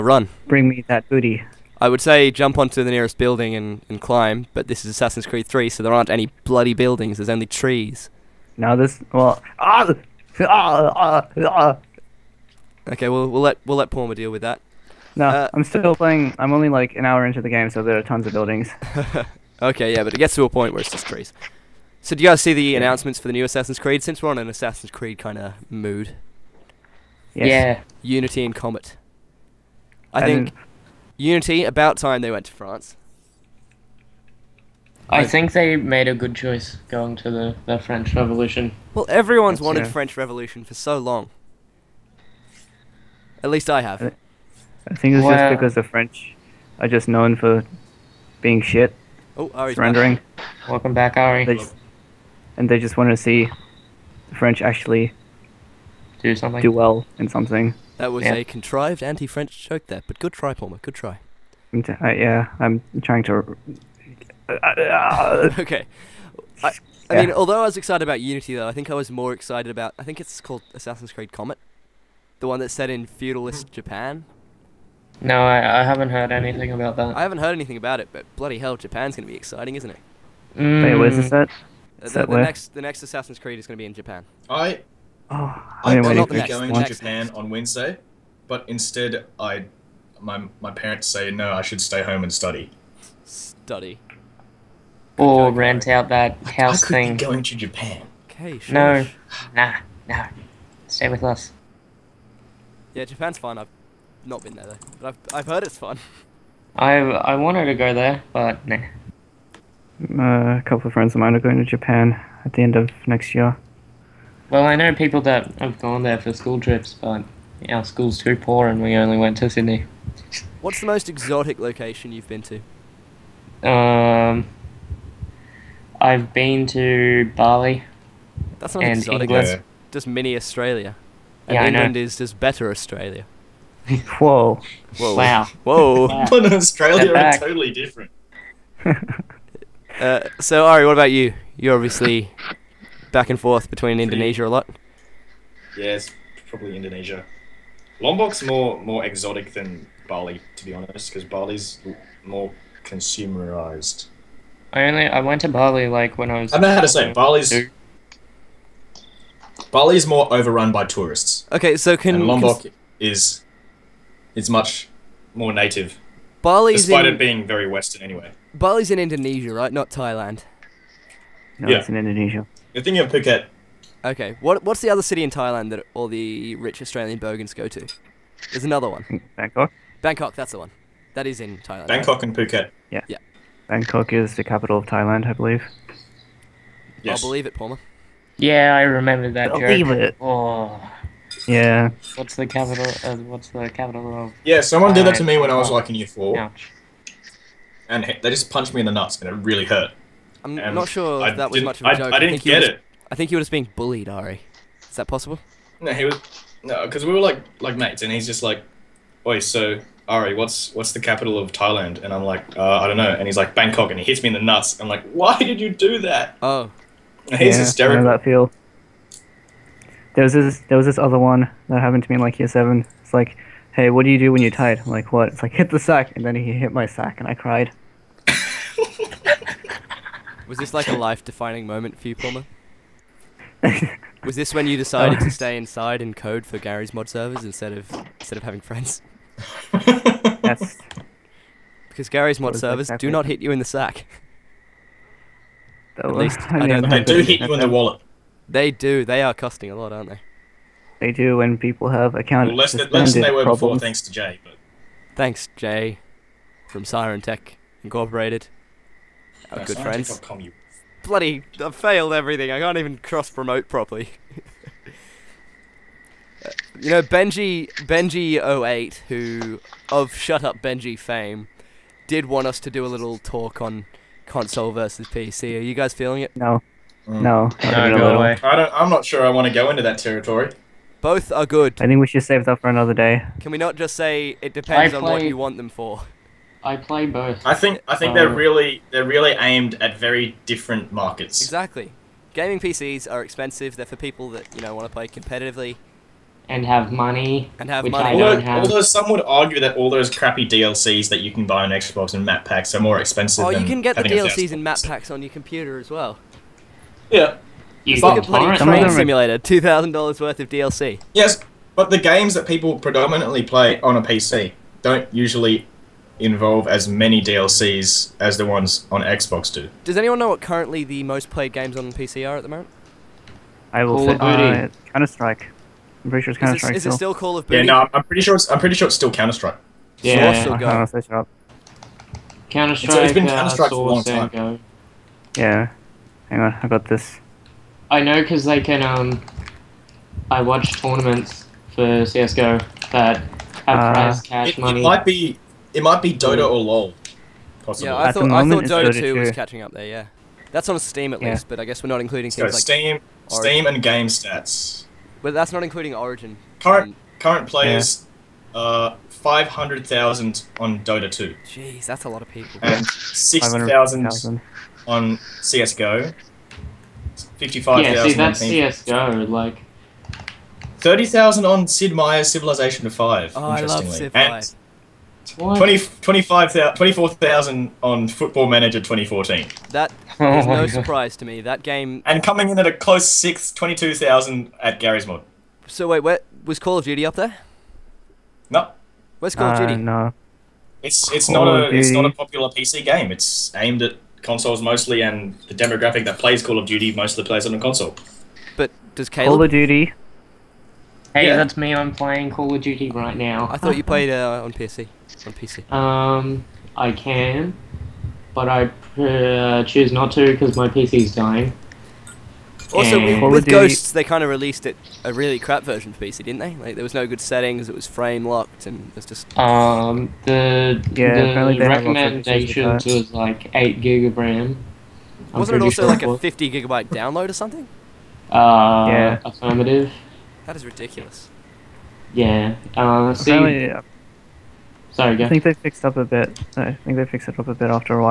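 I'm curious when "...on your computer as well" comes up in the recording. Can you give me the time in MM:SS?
05:05.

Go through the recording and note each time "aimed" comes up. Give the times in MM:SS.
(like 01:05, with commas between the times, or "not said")
04:49, 06:33.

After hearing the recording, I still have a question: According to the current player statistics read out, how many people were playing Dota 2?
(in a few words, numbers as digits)
500,000.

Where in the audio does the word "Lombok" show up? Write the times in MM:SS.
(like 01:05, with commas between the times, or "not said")
02:28, 02:42.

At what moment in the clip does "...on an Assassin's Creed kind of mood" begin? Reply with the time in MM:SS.
00:24.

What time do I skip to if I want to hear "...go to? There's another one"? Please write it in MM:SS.
02:57.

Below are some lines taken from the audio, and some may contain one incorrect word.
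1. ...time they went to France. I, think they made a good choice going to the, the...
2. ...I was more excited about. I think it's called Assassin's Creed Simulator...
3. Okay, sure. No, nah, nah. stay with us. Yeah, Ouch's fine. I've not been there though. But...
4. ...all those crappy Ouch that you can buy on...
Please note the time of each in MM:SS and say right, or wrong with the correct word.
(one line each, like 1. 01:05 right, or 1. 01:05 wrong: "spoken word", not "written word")
1. 00:31 right
2. 01:08 wrong: "Comet", not "Simulator"
3. 01:38 wrong: "Japan", not "Ouch"
4. 04:59 wrong: "DLCs", not "Ouch".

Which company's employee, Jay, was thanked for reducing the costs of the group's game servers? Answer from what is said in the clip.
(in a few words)
Siren Tech Incorporated.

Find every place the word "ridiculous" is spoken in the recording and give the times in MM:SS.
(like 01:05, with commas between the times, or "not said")
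07:10.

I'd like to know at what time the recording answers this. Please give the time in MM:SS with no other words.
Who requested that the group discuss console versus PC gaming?
04:27.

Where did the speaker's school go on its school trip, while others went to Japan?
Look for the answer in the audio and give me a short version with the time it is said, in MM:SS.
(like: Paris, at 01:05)
Sydney, at 01:59.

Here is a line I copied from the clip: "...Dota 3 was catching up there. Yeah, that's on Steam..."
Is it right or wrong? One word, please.
wrong.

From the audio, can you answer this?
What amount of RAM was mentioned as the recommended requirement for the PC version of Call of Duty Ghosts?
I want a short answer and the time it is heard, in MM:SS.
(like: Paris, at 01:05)
8 GB, at 07:03.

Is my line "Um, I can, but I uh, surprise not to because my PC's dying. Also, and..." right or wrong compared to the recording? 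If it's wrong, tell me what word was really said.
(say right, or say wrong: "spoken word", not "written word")
wrong: "choose", not "surprise".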